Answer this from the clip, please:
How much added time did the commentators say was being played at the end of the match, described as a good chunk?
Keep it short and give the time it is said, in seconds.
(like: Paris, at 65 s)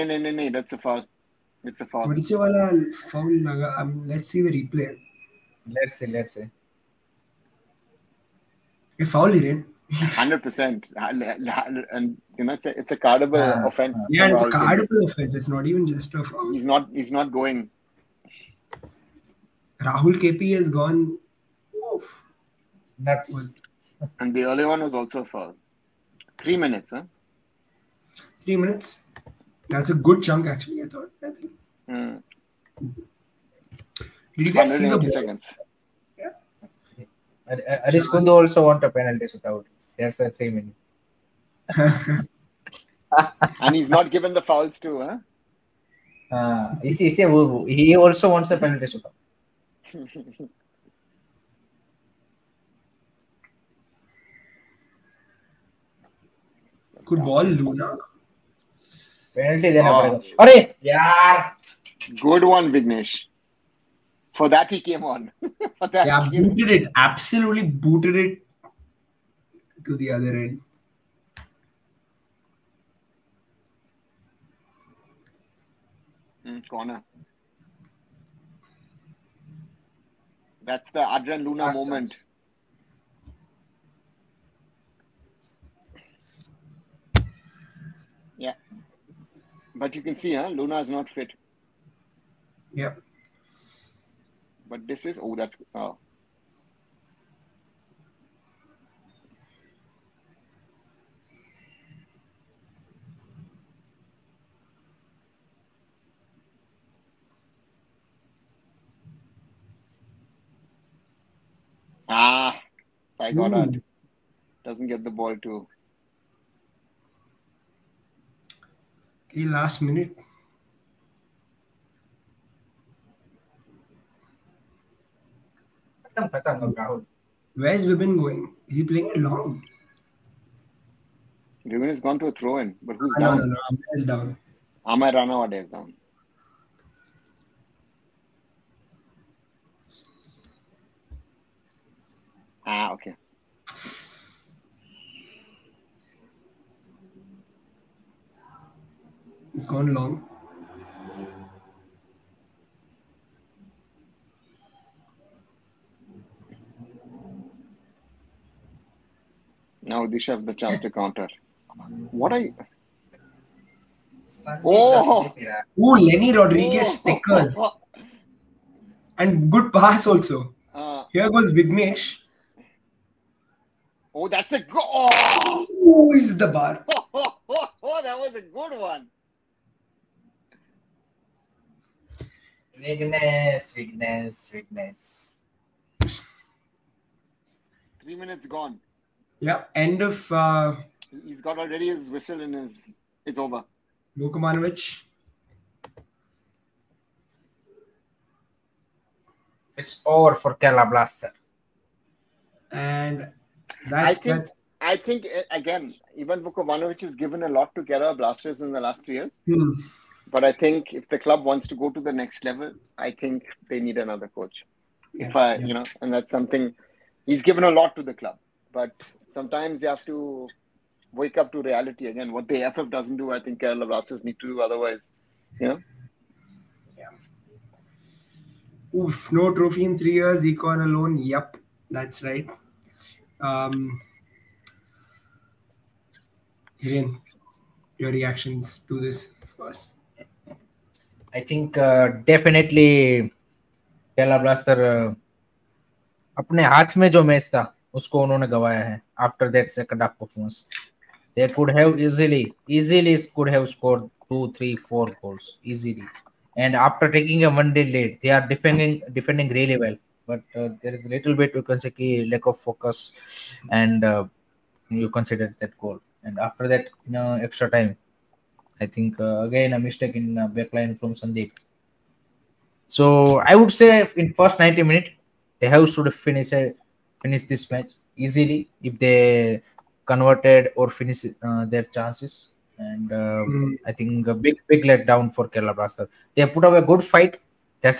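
3 minutes, at 26 s.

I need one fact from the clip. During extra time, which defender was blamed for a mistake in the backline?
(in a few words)
Sandeep.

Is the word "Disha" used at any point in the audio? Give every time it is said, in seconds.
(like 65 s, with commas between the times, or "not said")
160 s.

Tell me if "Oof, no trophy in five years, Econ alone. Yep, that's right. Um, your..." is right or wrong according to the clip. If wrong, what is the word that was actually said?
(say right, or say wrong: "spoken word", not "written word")
wrong: "three", not "five".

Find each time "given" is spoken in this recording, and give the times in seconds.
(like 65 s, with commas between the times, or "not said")
44 s, 207 s, 217 s.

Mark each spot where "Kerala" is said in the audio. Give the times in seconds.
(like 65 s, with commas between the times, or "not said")
200 s, 207 s, 223 s, 244 s, 285 s.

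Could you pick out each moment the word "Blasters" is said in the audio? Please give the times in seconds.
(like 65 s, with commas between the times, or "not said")
200 s, 208 s, 223 s, 244 s, 285 s.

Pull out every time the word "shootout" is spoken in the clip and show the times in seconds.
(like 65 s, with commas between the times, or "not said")
39 s, 48 s.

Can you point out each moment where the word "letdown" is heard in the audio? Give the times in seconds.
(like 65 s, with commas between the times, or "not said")
284 s.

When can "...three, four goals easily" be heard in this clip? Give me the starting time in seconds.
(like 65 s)
254 s.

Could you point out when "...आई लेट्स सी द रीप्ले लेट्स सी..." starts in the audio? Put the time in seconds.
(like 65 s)
3 s.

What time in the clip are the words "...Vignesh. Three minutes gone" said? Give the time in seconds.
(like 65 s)
186 s.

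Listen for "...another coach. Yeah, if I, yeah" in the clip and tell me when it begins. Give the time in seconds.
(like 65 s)
213 s.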